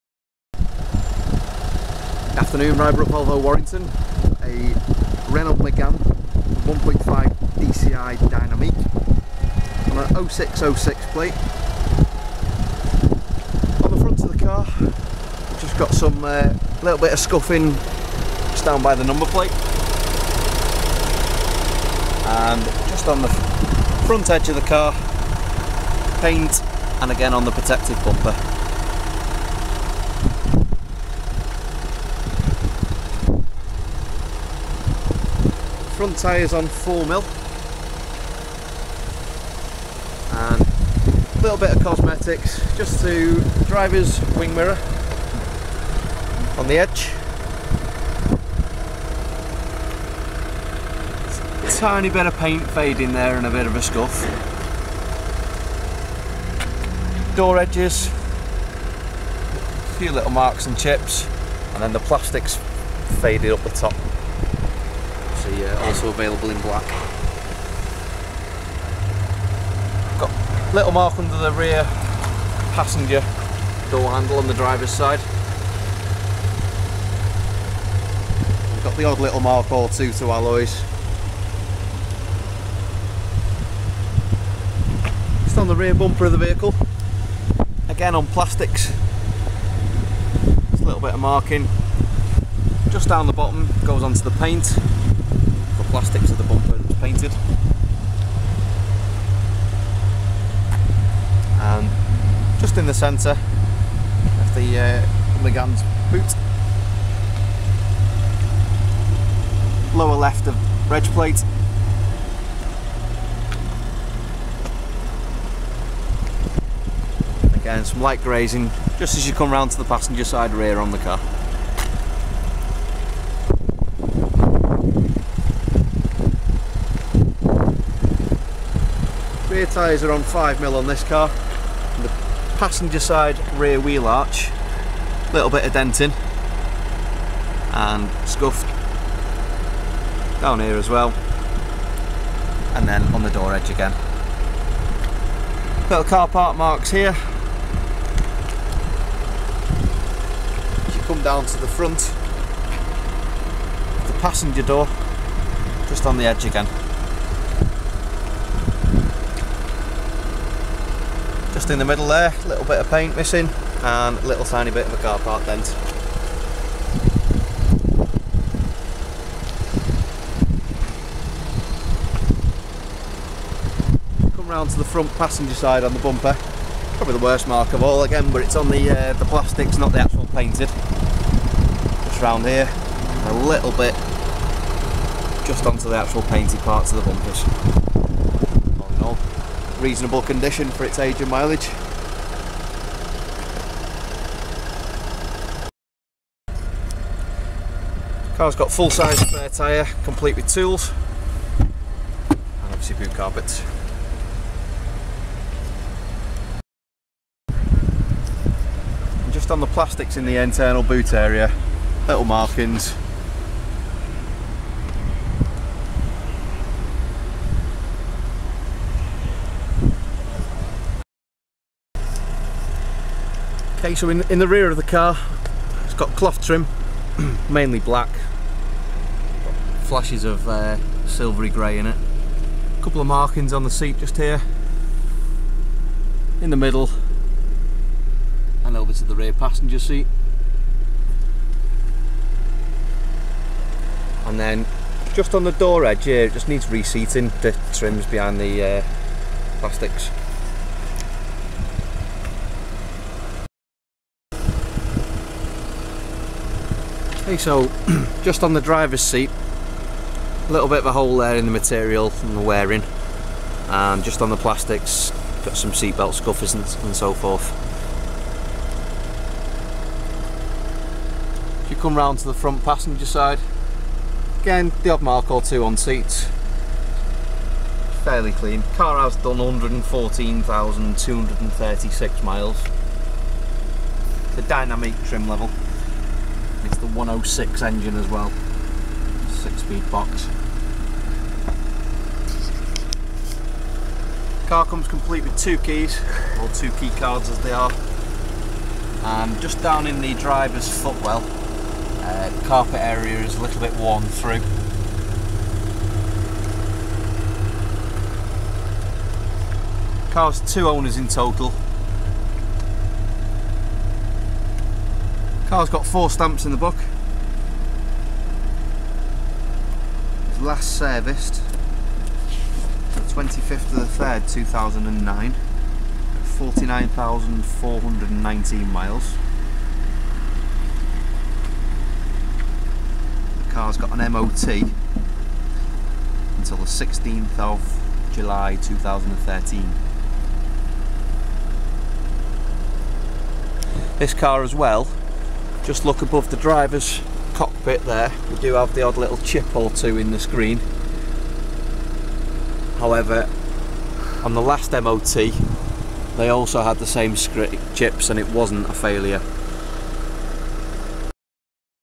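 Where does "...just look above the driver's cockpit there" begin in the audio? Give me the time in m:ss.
5:45.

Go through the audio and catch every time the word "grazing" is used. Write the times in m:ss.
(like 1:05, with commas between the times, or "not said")
1:58.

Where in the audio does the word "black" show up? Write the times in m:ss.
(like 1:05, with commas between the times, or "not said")
1:06, 3:47.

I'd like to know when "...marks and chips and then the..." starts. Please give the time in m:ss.
1:00.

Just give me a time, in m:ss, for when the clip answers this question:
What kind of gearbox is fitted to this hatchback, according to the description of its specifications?
4:49.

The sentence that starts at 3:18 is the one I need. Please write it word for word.
Car's got full size spare tyre, complete with tools and obviously boot carpets.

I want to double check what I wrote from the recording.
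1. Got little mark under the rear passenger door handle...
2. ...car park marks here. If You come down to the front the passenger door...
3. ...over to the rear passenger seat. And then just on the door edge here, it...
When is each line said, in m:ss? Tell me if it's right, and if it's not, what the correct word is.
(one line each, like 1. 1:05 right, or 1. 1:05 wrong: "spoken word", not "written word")
1. 1:10 right
2. 2:26 right
3. 3:58 right.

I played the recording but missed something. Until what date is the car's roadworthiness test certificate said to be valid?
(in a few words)
16 July 2013.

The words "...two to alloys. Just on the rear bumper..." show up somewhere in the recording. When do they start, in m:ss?
1:19.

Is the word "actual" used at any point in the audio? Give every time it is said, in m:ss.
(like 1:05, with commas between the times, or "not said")
2:59, 3:05.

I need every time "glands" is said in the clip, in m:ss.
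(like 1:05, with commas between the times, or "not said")
not said.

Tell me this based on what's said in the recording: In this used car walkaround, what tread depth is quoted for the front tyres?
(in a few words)
4mm.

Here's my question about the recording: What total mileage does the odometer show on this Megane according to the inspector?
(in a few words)
114,236 miles.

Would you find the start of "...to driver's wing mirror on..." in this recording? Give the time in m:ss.
0:43.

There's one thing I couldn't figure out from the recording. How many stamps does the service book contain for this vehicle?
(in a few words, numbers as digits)
4.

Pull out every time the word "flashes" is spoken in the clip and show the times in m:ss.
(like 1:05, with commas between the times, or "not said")
3:49.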